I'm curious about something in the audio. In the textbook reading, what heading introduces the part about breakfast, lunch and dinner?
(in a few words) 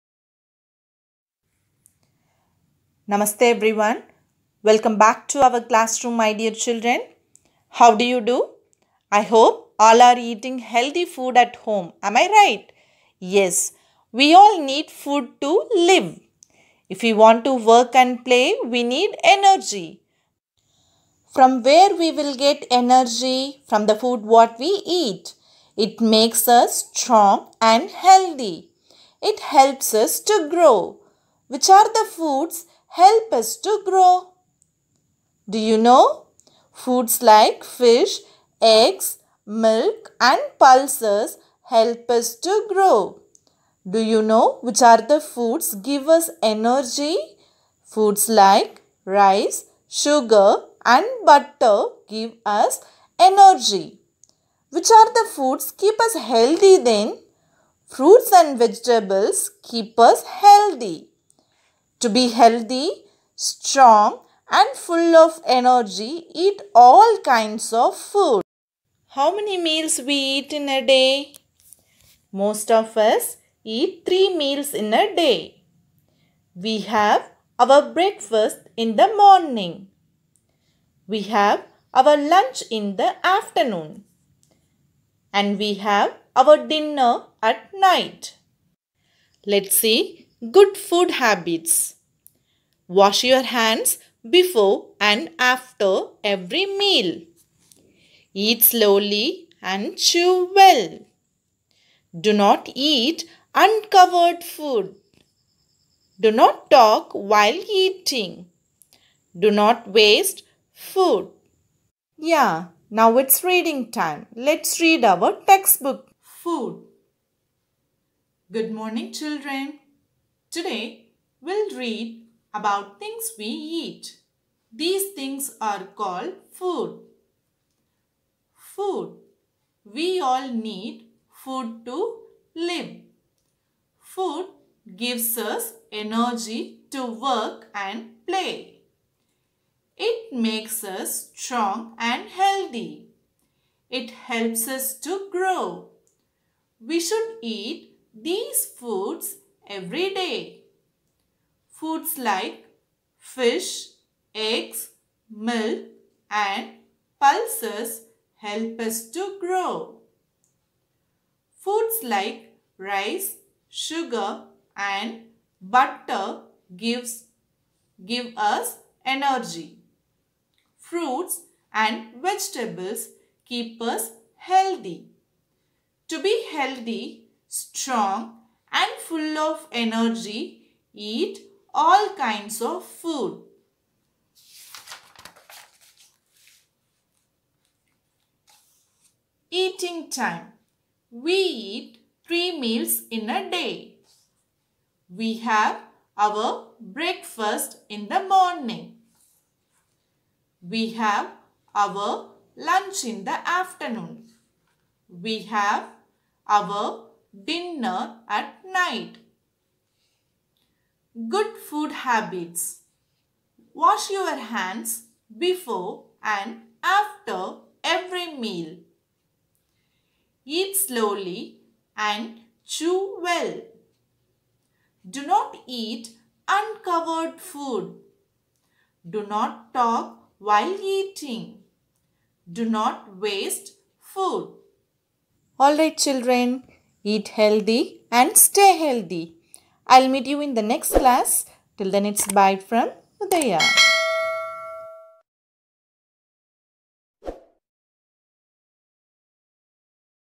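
Eating time.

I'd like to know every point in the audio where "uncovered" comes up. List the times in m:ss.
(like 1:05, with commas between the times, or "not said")
1:43, 3:46.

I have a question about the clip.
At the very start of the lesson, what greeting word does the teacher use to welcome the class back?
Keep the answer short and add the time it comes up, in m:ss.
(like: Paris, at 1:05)
Namaste, at 0:03.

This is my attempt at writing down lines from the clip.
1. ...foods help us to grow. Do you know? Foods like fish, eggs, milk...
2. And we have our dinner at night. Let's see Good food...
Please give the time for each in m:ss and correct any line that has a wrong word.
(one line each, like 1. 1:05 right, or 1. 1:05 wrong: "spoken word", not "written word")
1. 0:32 right
2. 1:25 right.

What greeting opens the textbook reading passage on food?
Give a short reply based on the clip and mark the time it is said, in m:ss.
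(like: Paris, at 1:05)
Good morning, at 1:58.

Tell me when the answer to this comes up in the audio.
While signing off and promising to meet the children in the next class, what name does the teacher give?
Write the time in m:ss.
4:03.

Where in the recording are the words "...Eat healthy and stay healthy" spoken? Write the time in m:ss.
3:57.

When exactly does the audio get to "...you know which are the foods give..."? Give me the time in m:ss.
0:43.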